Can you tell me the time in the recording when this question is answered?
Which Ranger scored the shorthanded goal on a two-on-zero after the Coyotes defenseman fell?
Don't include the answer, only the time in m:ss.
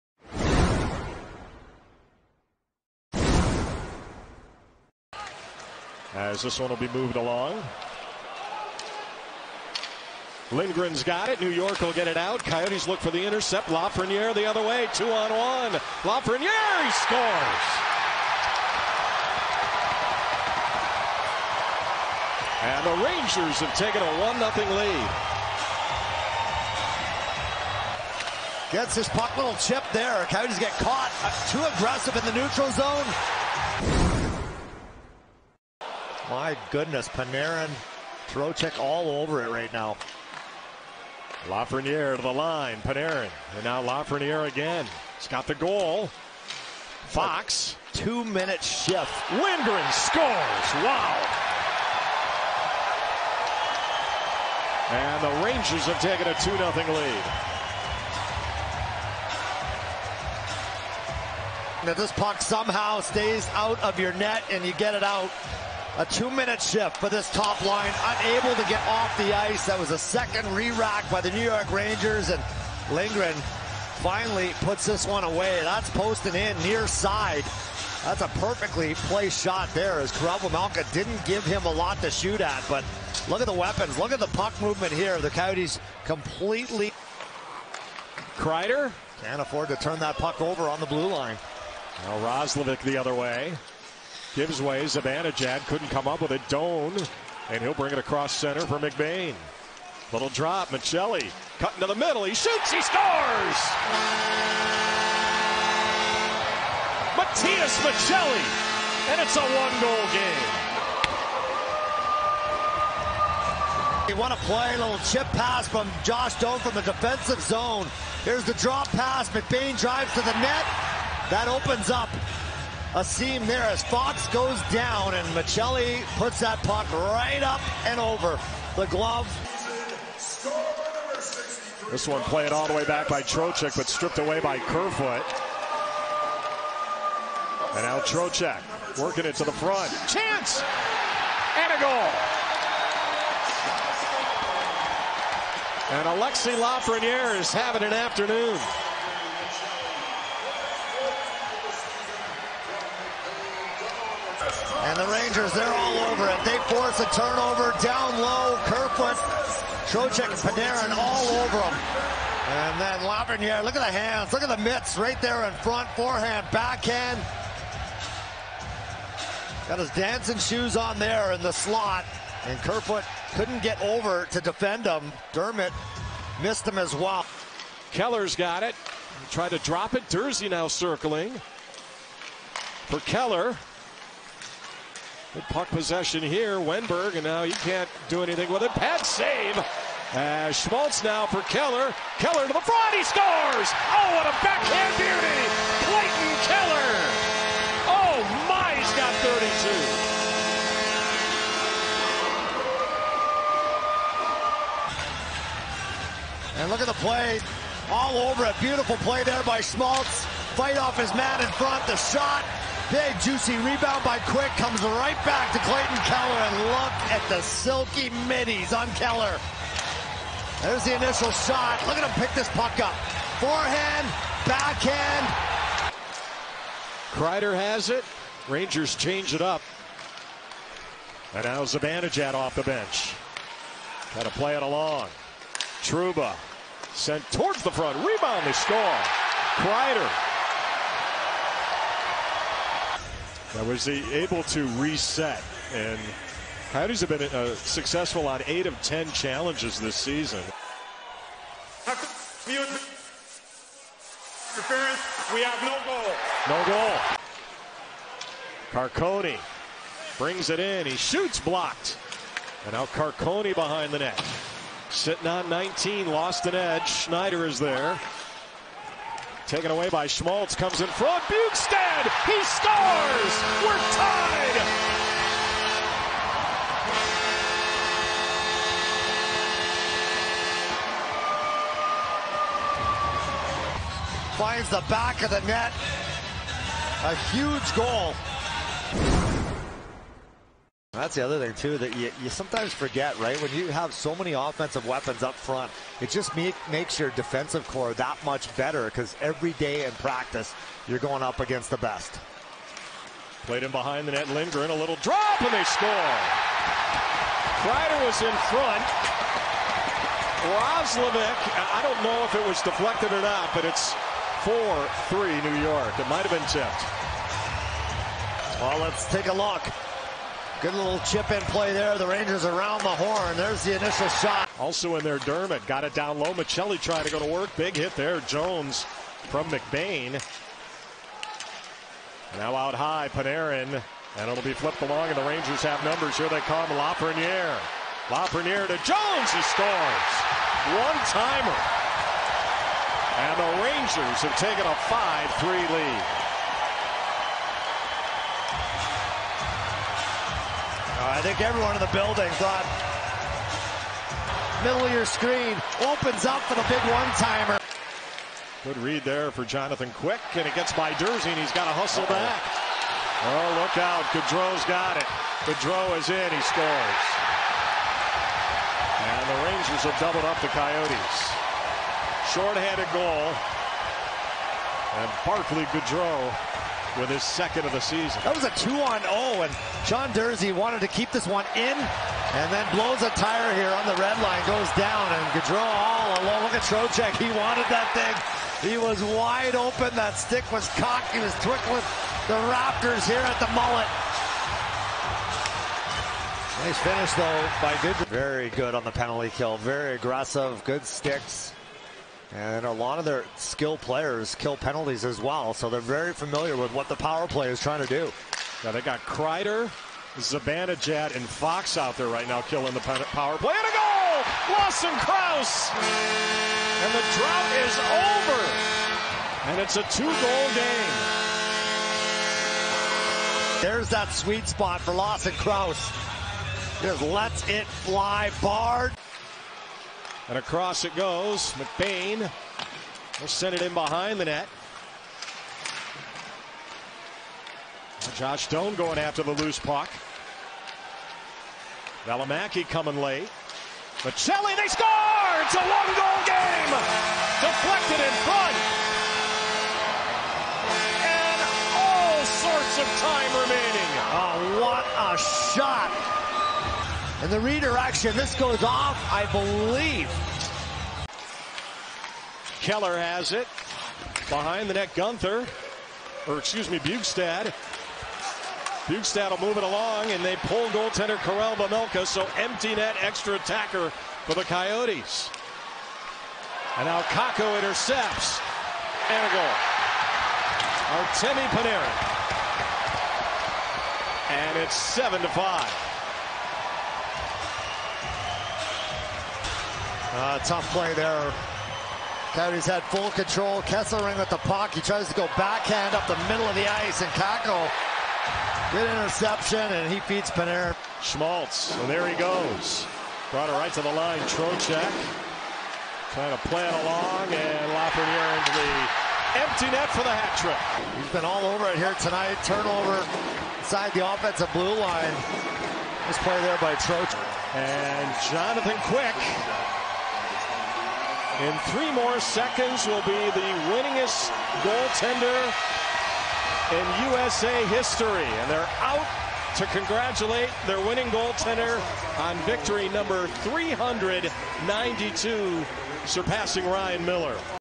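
6:15.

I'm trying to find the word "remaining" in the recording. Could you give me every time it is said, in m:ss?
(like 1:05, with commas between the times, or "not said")
7:33.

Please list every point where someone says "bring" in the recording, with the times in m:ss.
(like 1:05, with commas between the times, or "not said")
1:37, 4:20.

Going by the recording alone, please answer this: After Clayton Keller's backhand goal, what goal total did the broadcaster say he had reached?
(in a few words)
32.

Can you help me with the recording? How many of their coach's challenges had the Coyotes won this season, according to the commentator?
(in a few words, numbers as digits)
8 of 10.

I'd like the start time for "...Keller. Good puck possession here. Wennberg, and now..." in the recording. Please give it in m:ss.
3:03.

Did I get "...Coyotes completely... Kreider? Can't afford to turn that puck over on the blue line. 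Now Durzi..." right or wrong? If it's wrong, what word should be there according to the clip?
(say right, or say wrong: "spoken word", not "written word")
wrong: "Roslovic", not "Durzi".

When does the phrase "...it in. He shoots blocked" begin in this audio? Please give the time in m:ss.
4:20.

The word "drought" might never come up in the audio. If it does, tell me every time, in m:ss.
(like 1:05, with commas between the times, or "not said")
6:57.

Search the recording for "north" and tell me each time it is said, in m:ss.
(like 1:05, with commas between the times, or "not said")
not said.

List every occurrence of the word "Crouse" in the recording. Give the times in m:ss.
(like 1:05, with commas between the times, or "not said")
6:54, 7:05.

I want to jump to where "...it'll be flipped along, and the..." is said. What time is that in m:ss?
5:34.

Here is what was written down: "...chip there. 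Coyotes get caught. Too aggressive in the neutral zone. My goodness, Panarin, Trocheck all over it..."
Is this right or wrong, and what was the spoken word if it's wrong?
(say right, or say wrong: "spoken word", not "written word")
right.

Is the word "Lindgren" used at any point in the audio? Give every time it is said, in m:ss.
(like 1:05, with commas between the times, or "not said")
0:10, 0:49, 1:12, 5:04.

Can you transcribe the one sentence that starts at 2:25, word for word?
And Alexi Lafreniere is having an afternoon.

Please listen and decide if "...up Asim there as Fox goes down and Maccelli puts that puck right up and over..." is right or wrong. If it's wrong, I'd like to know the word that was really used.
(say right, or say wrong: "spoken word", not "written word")
right.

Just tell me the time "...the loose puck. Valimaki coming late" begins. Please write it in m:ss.
7:19.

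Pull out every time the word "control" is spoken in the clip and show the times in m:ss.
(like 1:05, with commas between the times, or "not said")
8:13.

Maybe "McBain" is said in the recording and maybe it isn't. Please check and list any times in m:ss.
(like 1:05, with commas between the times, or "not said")
1:38, 1:59, 5:29, 7:11.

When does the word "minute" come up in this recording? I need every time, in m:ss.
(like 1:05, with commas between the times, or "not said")
0:47, 1:06.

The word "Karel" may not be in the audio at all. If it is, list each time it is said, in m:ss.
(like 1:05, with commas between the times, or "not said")
1:20, 7:51.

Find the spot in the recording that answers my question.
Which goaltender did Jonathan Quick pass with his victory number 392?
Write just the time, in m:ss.
8:56.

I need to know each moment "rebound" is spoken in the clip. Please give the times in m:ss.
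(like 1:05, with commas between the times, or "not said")
3:33, 3:58.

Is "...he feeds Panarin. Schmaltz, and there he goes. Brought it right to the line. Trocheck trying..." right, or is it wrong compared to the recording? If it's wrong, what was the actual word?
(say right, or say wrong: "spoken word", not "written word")
right.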